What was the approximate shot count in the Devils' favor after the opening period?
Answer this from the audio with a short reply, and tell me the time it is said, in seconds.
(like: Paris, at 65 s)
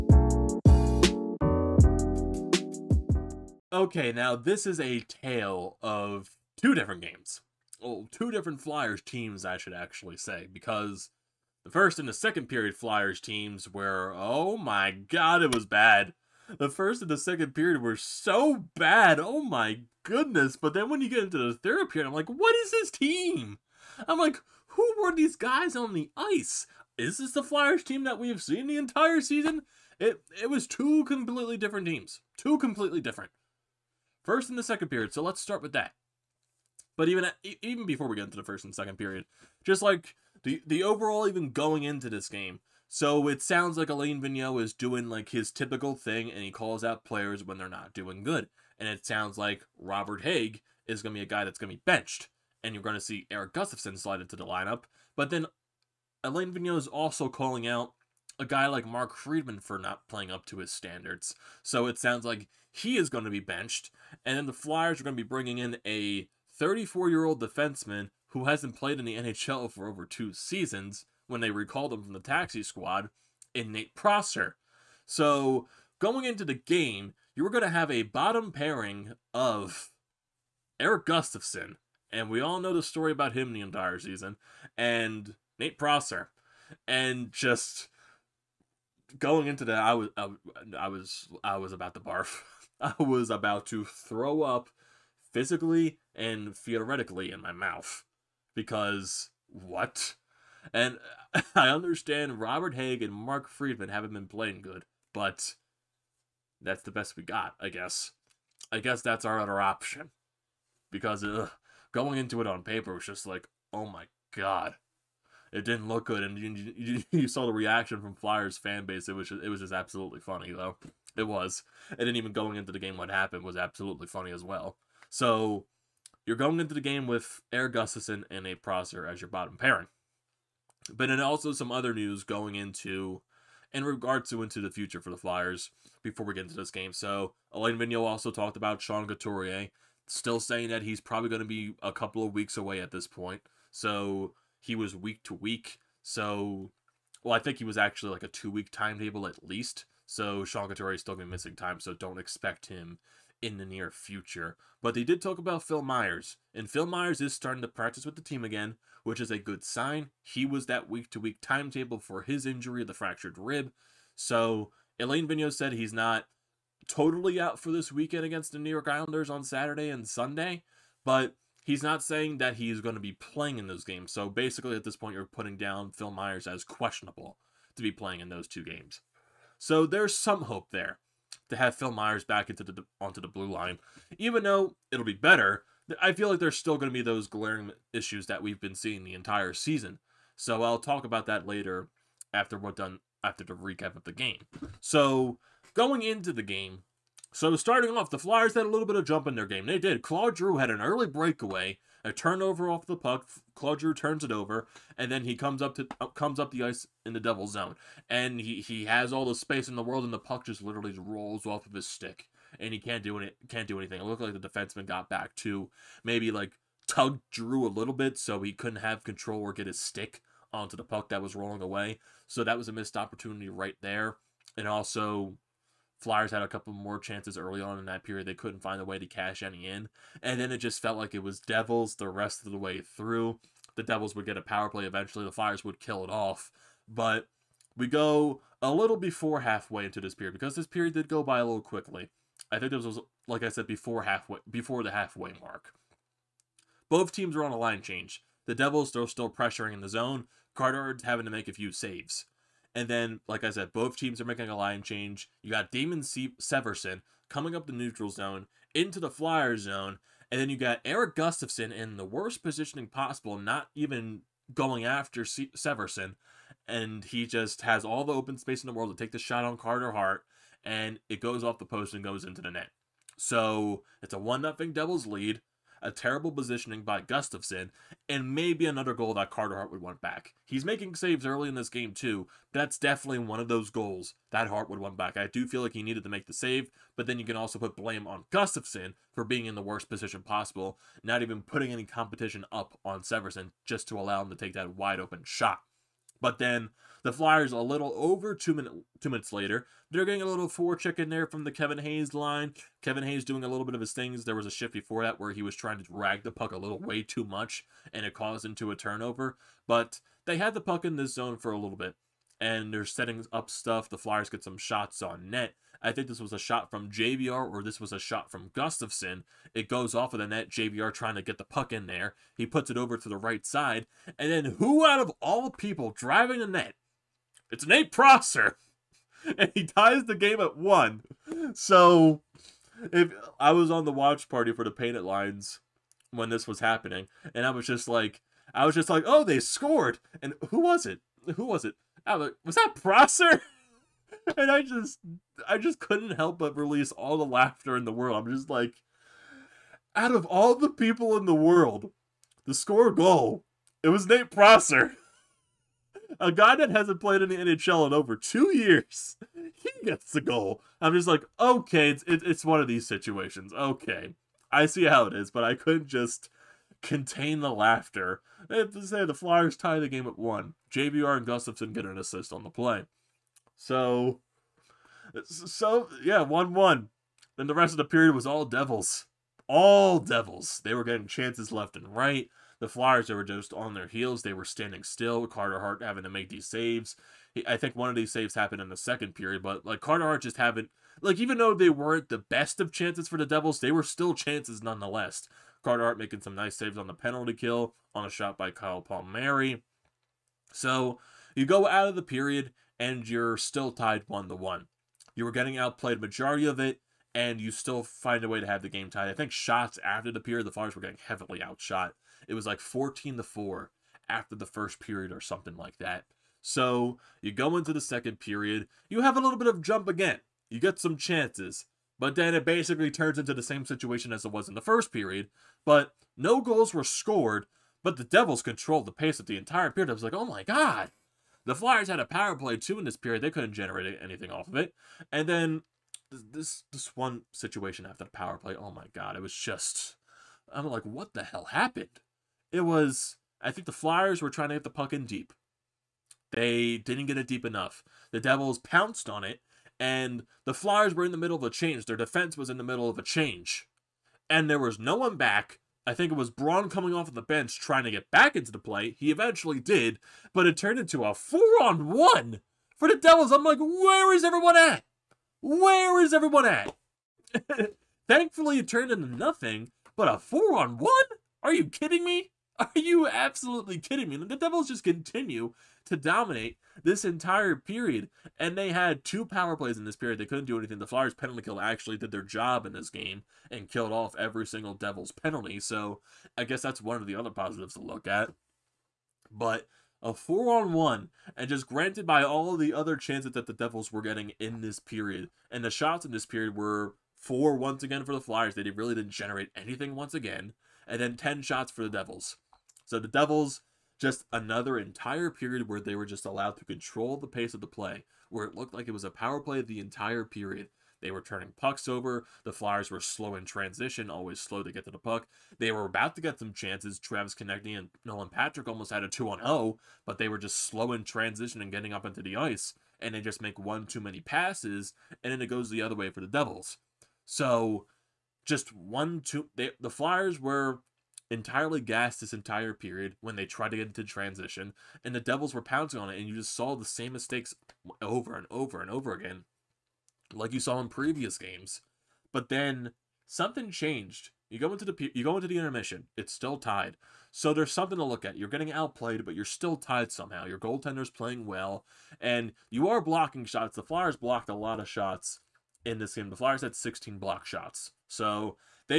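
14 to 4, at 412 s.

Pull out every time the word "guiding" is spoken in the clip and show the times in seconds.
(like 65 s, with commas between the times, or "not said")
not said.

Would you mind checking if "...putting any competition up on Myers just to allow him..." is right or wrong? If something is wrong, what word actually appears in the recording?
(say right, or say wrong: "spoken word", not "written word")
wrong: "Severson", not "Myers".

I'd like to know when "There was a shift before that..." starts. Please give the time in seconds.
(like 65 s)
304 s.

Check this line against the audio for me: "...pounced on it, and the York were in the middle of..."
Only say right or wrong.
wrong.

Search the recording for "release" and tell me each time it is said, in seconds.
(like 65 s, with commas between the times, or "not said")
346 s.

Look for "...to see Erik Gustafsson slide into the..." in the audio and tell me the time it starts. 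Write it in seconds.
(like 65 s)
52 s.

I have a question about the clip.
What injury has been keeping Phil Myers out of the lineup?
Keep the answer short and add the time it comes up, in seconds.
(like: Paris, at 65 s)
fractured rib, at 162 s.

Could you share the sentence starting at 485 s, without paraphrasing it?
So I guess that's one of the other positives to look at.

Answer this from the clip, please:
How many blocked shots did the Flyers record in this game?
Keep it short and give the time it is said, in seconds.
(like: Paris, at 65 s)
16, at 556 s.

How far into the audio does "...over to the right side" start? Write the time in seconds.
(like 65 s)
322 s.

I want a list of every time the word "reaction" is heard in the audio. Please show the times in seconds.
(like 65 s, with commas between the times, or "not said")
117 s.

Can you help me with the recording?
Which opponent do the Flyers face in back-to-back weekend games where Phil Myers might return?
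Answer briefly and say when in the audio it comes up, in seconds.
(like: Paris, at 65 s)
New York Islanders, at 168 s.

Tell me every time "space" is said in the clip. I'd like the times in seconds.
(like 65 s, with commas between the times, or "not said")
209 s, 268 s.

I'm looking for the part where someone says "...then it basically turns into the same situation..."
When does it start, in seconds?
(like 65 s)
422 s.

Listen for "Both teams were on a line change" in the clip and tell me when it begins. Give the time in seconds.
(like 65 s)
246 s.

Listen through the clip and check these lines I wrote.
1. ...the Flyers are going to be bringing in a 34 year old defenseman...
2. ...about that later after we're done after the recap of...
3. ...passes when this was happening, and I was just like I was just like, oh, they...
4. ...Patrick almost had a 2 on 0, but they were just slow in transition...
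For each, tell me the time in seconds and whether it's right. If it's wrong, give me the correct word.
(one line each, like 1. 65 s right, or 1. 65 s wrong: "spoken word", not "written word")
1. 64 s right
2. 191 s right
3. 335 s wrong: "lines", not "passes"
4. 518 s right.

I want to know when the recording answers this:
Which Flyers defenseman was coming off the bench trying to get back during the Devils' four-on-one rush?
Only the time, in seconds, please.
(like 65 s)
456 s.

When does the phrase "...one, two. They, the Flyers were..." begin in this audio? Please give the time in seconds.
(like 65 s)
528 s.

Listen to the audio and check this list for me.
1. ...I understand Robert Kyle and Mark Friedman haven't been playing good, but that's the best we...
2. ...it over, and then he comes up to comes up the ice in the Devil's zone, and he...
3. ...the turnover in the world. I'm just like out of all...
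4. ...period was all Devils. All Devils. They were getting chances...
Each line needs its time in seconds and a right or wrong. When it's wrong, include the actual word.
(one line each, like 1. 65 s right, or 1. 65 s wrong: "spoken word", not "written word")
1. 101 s wrong: "Hagg", not "Kyle"
2. 204 s right
3. 347 s wrong: "laughter", not "turnover"
4. 377 s right.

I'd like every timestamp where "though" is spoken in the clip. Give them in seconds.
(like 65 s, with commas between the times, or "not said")
120 s, 184 s, 391 s.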